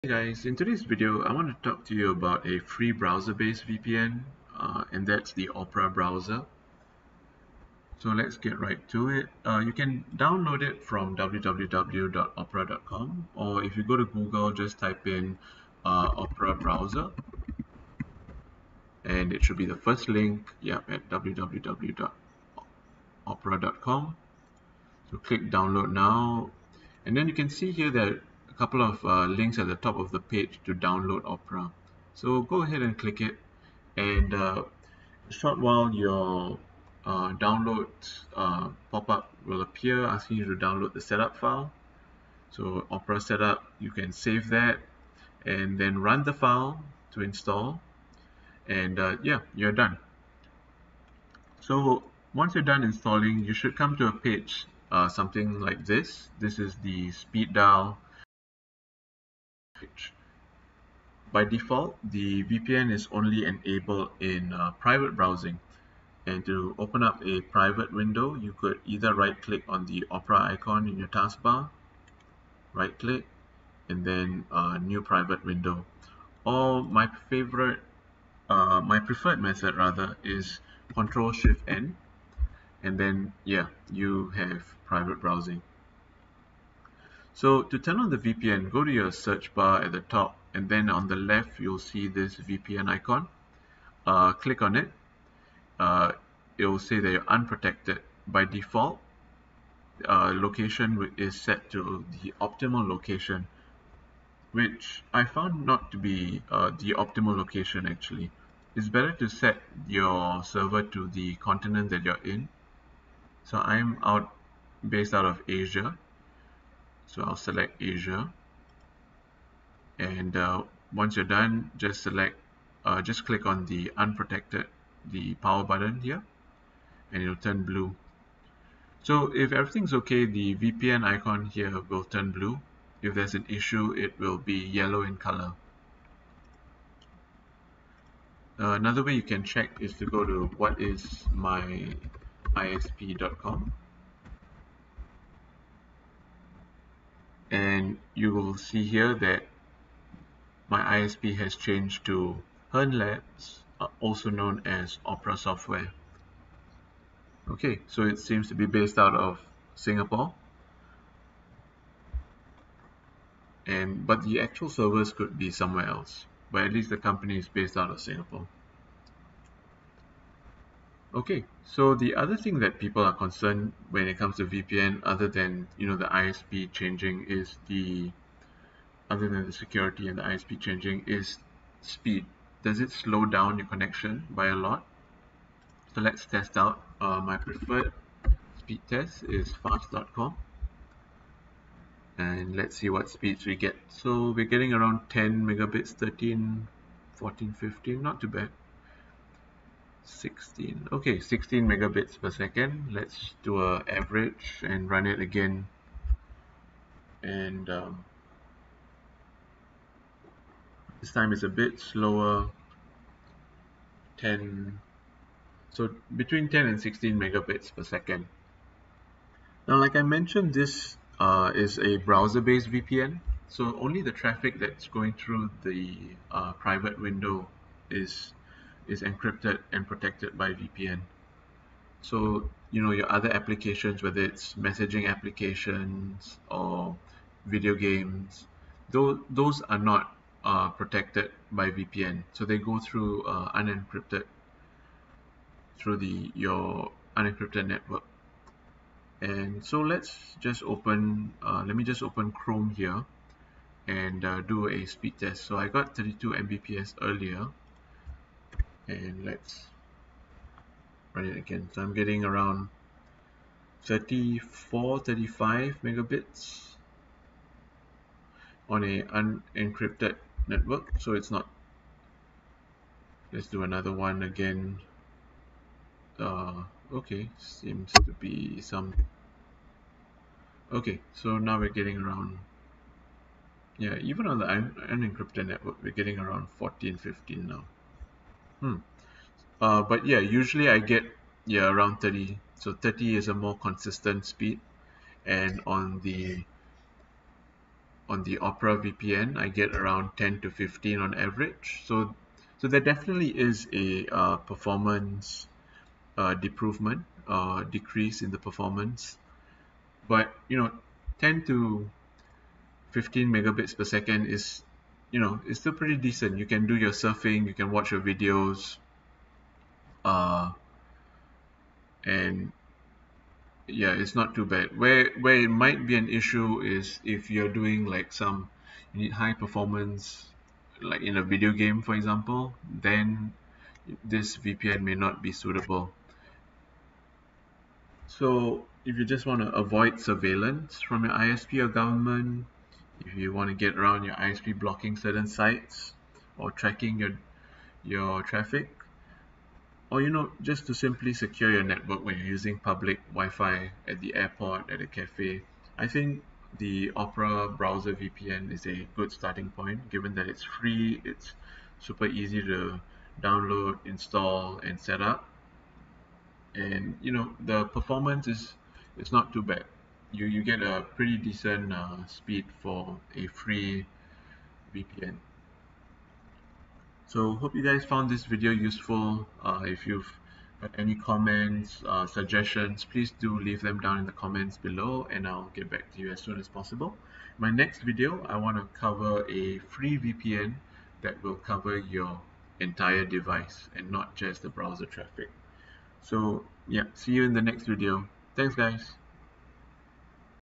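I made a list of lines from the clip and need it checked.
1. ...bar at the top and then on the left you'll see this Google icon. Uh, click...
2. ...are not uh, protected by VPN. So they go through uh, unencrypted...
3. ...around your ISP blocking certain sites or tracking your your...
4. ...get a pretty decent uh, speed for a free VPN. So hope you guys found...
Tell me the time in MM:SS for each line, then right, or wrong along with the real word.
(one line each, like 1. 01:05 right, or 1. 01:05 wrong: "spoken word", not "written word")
1. 01:29 wrong: "VPN", not "Google"
2. 03:59 right
3. 05:43 right
4. 06:10 right.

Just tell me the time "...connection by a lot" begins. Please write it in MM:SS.
03:03.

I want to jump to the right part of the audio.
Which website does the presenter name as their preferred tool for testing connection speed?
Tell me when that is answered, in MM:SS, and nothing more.
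03:09.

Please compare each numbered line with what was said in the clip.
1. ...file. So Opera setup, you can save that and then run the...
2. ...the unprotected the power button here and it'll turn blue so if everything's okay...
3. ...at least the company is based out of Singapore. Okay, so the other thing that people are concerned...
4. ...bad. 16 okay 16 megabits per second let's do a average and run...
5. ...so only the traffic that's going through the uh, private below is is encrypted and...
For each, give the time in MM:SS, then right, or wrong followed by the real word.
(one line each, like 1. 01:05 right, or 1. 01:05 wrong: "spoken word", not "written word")
1. 00:41 right
2. 02:03 right
3. 02:46 right
4. 03:18 right
5. 03:43 wrong: "window", not "below".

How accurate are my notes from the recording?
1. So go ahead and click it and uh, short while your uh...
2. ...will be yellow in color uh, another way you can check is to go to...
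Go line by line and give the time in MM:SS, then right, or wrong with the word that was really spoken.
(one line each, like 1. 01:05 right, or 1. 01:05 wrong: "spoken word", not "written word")
1. 00:32 right
2. 02:14 right.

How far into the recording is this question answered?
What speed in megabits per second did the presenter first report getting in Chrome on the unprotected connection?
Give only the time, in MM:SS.
04:15.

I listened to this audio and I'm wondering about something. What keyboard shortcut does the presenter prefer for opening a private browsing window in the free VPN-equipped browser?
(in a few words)
Control Shift N.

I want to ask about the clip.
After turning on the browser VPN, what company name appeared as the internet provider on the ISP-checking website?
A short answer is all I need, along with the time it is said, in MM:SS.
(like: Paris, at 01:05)
Hearn Labs, at 02:32.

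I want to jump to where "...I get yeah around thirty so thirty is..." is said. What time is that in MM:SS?
04:50.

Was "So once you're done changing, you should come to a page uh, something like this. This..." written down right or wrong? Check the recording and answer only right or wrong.
wrong.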